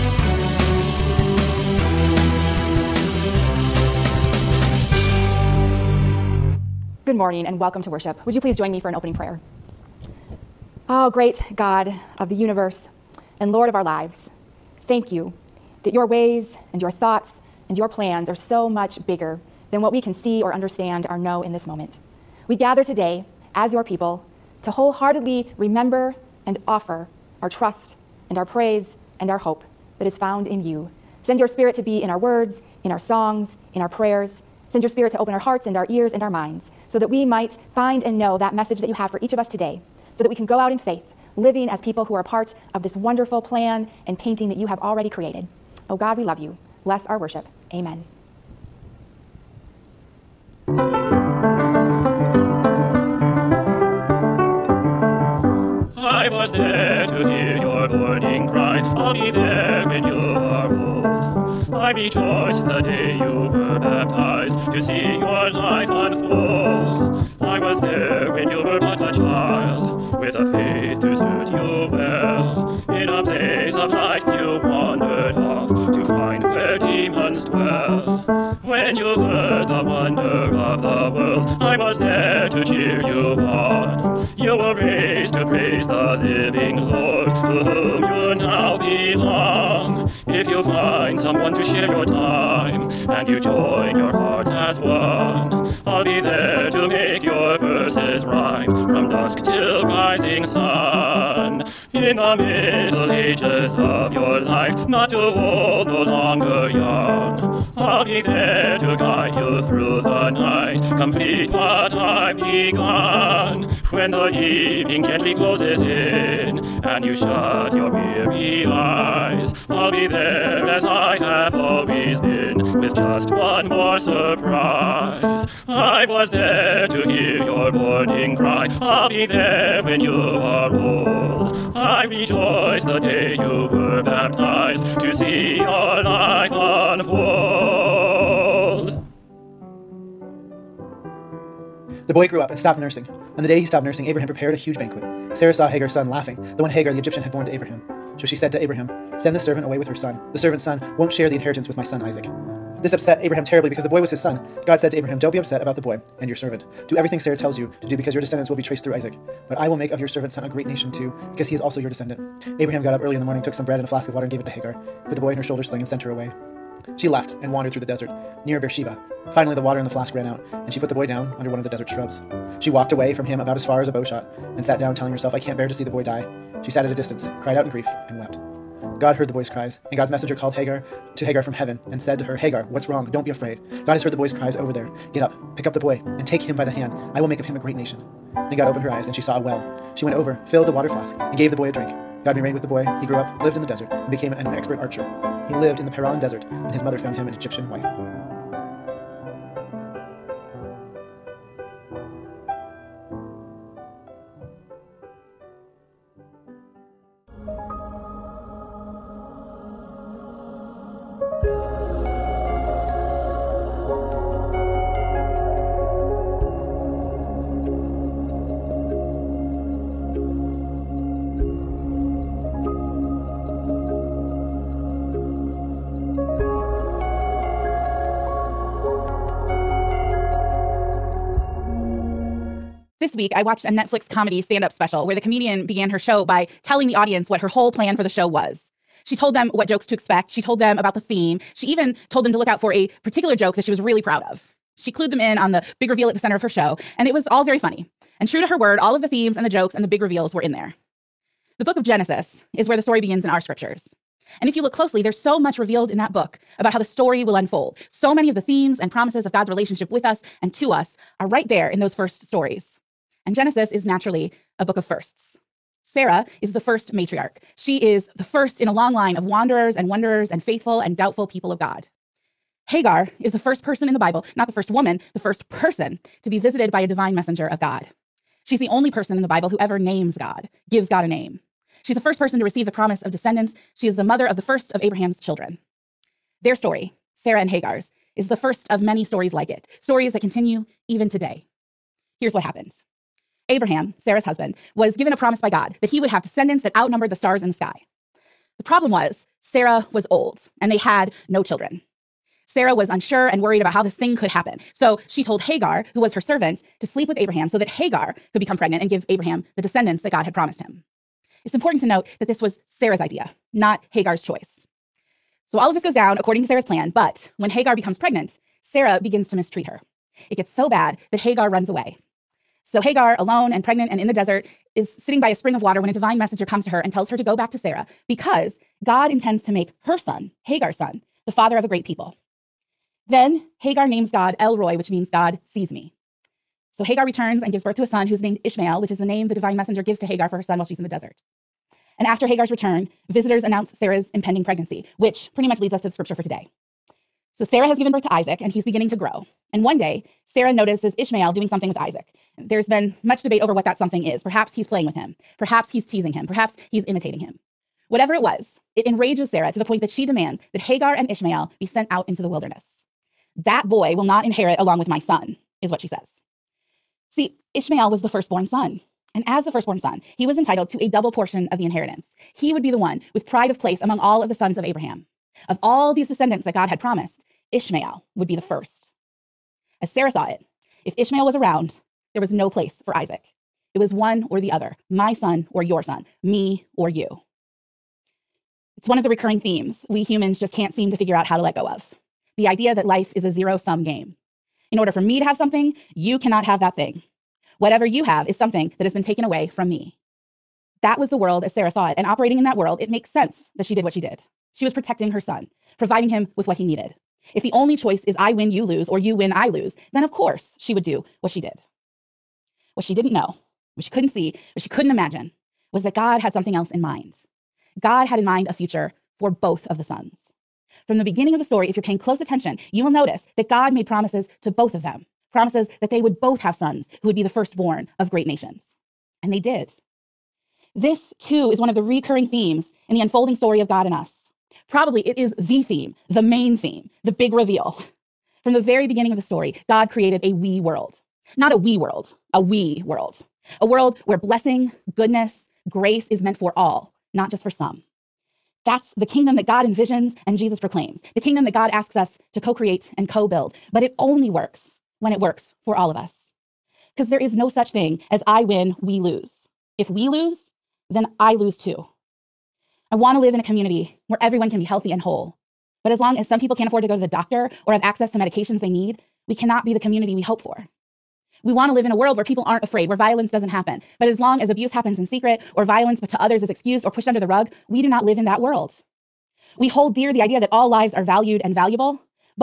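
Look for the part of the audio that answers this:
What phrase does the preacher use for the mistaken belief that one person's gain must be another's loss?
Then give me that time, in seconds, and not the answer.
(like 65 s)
393 s.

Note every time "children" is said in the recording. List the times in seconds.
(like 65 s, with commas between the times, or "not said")
285 s, 301 s.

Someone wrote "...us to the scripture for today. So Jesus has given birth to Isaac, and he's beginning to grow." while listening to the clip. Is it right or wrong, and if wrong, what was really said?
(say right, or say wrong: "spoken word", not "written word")
wrong: "Sarah", not "Jesus".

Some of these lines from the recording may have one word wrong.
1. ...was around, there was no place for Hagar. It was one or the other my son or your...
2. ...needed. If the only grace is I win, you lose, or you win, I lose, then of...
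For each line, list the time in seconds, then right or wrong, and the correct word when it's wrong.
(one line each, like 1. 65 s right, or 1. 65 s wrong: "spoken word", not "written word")
1. 381 s wrong: "Isaac", not "Hagar"
2. 406 s wrong: "choice", not "grace".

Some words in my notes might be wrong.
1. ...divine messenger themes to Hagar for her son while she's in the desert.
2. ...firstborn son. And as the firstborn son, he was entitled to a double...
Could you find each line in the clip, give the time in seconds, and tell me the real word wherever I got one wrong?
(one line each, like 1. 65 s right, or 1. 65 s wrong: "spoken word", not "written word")
1. 339 s wrong: "gives", not "themes"
2. 368 s right.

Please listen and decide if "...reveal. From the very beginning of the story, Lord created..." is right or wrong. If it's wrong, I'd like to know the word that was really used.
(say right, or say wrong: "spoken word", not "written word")
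wrong: "God", not "Lord".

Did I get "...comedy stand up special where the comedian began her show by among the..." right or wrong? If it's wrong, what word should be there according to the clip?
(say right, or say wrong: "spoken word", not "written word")
wrong: "telling", not "among".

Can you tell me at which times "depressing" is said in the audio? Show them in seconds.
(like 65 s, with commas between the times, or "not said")
not said.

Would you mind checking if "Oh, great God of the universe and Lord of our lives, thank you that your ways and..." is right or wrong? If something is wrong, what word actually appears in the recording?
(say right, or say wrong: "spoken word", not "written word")
right.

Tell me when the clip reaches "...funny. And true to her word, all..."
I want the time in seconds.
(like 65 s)
247 s.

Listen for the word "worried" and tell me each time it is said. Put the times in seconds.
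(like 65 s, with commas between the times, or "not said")
303 s.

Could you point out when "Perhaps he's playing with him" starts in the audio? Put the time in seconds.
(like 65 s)
354 s.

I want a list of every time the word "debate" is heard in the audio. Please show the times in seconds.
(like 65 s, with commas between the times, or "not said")
353 s.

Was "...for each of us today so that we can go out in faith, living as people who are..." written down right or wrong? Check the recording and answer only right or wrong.
right.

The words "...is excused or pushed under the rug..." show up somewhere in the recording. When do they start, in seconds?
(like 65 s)
476 s.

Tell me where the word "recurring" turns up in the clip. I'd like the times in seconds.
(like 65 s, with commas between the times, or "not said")
389 s, 431 s.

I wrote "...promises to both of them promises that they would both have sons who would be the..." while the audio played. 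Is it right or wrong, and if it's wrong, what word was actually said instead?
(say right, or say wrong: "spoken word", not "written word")
right.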